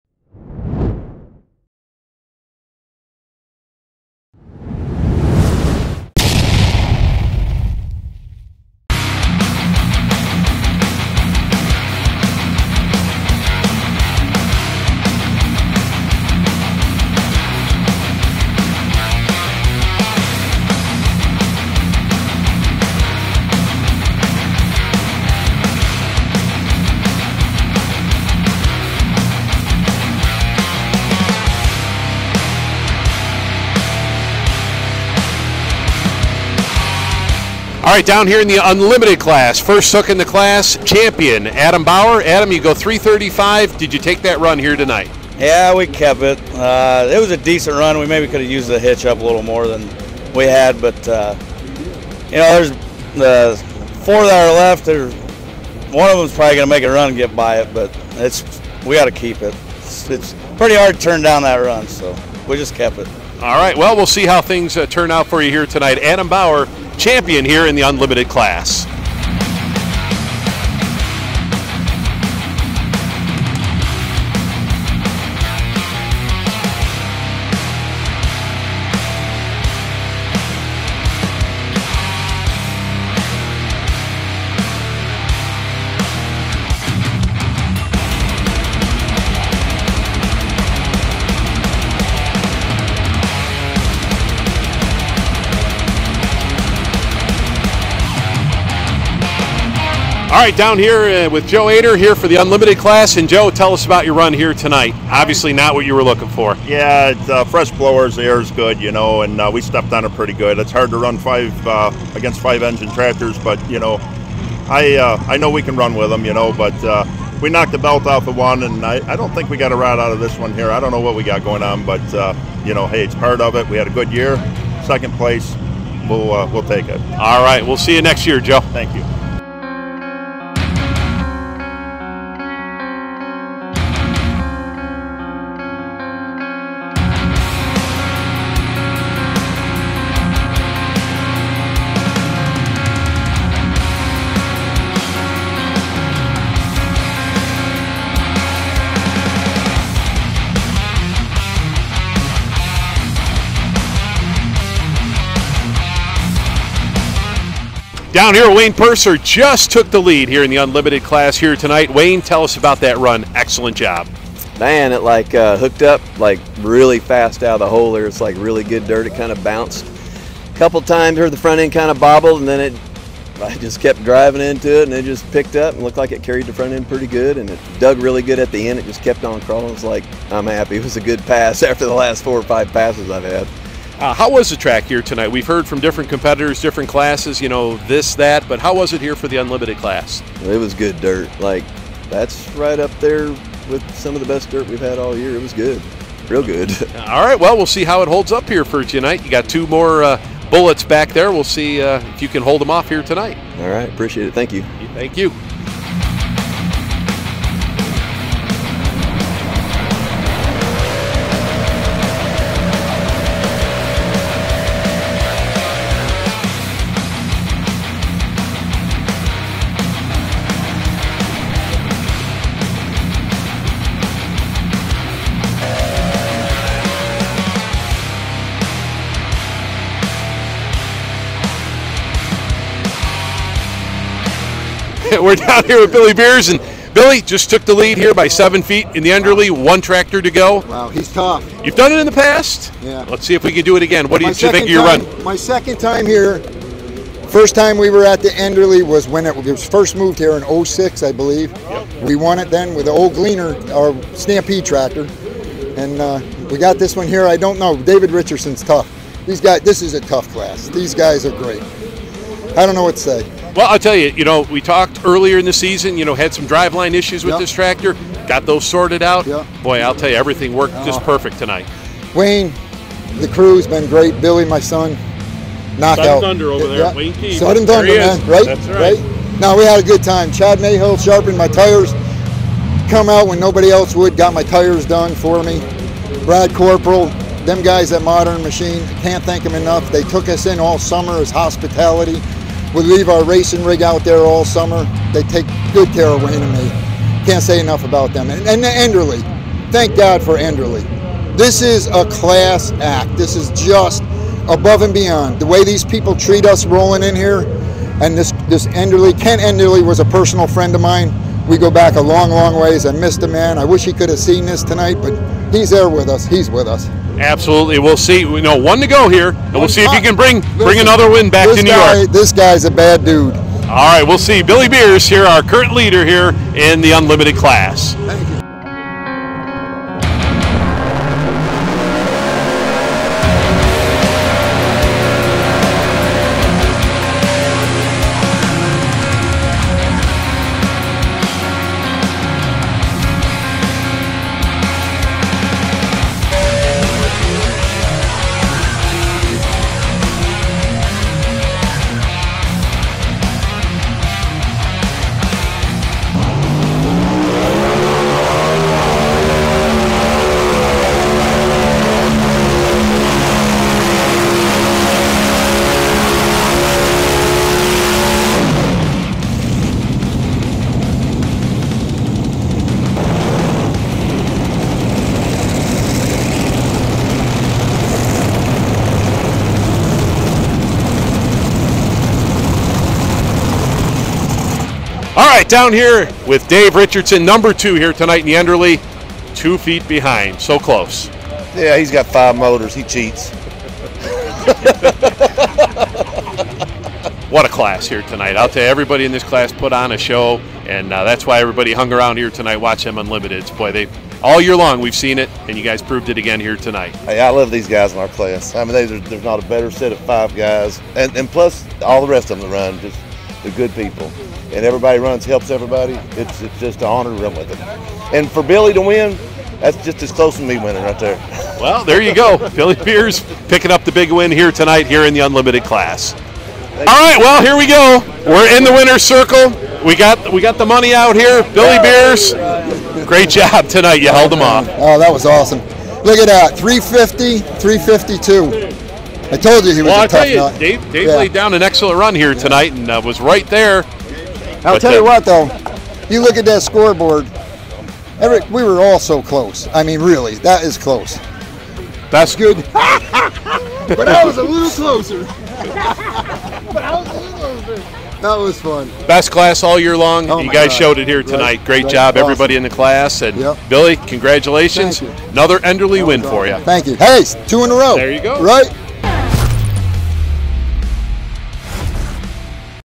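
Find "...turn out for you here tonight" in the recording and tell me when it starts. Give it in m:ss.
1:04.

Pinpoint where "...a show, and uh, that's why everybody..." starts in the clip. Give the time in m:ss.
6:39.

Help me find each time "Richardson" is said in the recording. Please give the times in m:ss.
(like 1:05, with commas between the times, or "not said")
4:18, 6:26.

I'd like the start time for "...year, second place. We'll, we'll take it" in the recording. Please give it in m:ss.
2:04.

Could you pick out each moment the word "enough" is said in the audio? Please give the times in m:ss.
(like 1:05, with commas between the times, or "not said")
4:49, 4:57.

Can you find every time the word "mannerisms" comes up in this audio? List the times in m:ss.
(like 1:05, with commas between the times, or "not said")
not said.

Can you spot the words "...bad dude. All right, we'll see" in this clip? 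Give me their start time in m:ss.
5:22.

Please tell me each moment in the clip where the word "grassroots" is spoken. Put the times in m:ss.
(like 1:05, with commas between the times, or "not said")
not said.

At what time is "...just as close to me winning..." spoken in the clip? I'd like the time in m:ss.
6:59.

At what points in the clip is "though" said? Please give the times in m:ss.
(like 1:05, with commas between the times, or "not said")
7:25.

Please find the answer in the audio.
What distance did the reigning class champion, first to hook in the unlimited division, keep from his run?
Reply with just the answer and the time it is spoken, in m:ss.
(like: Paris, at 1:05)
335, at 0:42.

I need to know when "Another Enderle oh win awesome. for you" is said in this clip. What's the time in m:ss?
7:45.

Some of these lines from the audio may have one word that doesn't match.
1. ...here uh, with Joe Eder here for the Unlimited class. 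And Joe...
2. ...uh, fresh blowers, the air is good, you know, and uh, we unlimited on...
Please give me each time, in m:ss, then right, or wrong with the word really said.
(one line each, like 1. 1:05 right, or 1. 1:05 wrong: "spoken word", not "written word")
1. 1:40 right
2. 1:47 wrong: "stepped", not "unlimited".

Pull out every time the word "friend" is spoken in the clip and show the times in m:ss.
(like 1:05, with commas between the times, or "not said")
5:10.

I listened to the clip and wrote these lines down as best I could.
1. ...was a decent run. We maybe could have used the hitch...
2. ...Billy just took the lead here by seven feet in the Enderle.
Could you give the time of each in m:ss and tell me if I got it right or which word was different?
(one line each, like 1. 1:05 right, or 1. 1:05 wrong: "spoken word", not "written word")
1. 0:47 right
2. 3:56 right.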